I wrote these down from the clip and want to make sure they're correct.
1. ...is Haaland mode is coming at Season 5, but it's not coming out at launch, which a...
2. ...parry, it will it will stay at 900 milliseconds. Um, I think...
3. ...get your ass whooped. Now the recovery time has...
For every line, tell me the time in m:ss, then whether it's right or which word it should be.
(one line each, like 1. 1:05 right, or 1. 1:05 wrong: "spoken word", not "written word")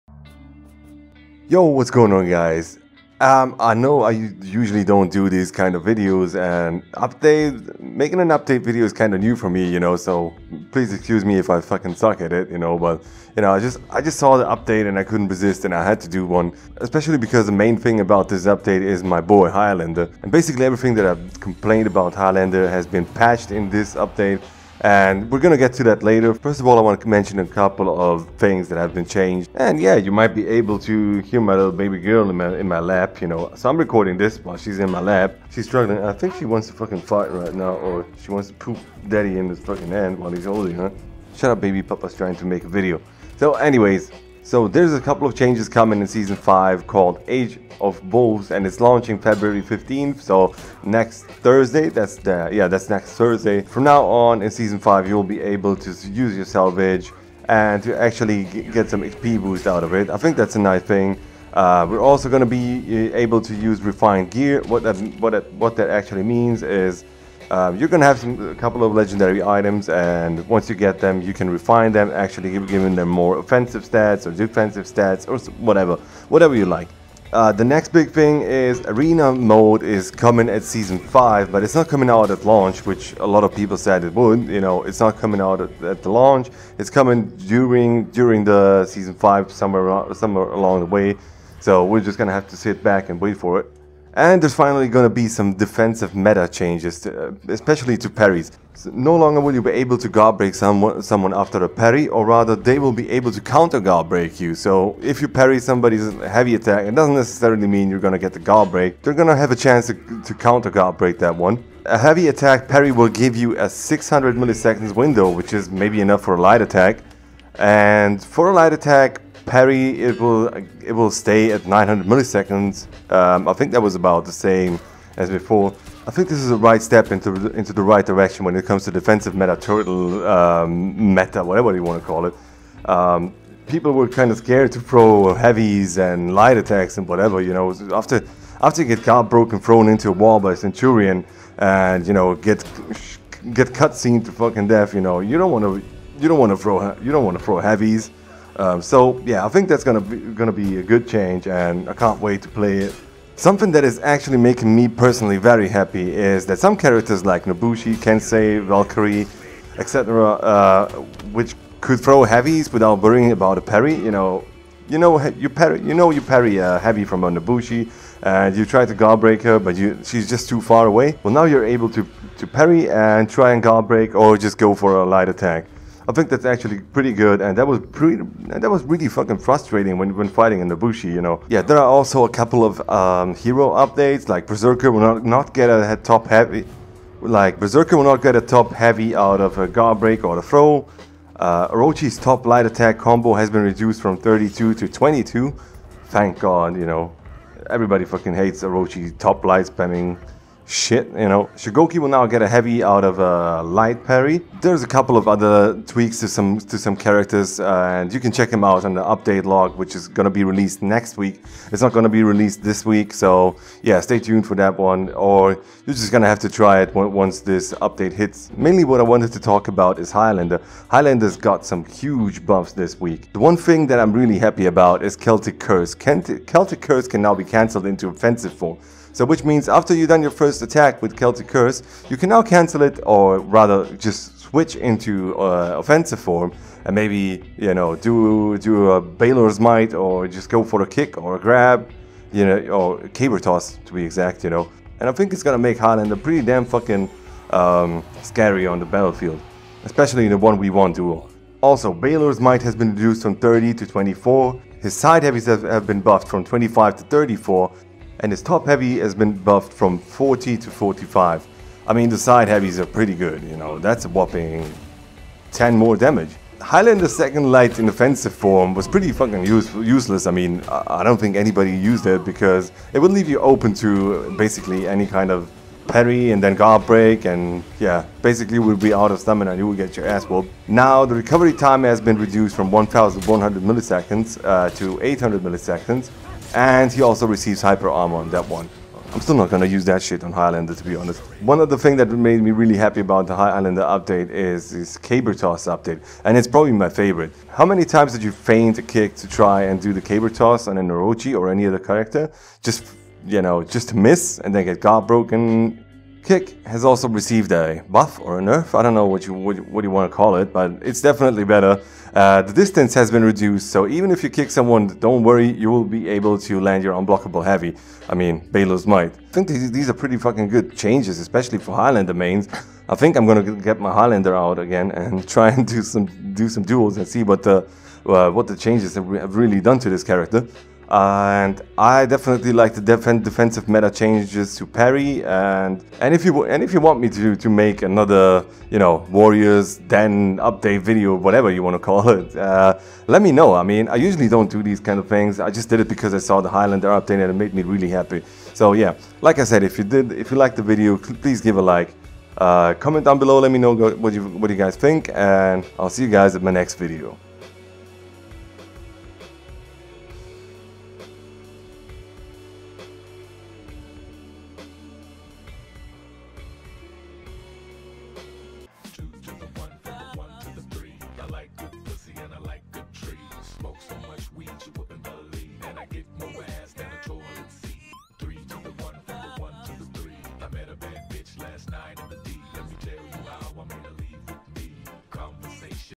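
1. 1:18 wrong: "Arena", not "Haaland"
2. 1:59 right
3. 4:39 right.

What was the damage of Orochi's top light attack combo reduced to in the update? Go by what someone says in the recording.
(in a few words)
22.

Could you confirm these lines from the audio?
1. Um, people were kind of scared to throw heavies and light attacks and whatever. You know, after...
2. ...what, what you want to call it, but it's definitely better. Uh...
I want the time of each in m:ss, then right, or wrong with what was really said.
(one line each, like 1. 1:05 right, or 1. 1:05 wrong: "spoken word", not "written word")
1. 2:12 right
2. 5:09 right.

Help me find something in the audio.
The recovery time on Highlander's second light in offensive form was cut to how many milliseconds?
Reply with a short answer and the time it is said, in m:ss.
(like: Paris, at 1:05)
800 milliseconds, at 4:45.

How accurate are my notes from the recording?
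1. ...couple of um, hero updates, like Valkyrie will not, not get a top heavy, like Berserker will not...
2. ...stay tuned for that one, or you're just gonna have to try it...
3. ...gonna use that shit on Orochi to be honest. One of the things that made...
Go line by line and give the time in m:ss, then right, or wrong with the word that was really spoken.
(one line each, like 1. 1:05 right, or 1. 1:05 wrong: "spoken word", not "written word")
1. 3:02 wrong: "Berserker", not "Valkyrie"
2. 3:33 right
3. 4:49 wrong: "Highlander", not "Orochi".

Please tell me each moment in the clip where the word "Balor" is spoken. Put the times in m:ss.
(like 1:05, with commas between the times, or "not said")
3:59, 4:11, 5:18.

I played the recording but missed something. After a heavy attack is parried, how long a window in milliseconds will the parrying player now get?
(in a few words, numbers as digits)
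600 milliseconds.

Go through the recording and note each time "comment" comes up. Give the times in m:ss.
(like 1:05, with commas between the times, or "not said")
5:52.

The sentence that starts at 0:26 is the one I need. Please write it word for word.
First of all, I want to mention a couple of things that have been changed.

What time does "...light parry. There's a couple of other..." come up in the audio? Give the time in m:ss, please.
3:23.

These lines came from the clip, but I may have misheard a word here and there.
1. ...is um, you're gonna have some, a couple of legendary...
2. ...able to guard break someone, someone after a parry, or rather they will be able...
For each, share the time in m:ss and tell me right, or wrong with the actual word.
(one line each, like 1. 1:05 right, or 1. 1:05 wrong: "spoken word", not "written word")
1. 1:06 right
2. 1:39 right.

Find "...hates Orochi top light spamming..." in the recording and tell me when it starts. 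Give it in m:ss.
3:18.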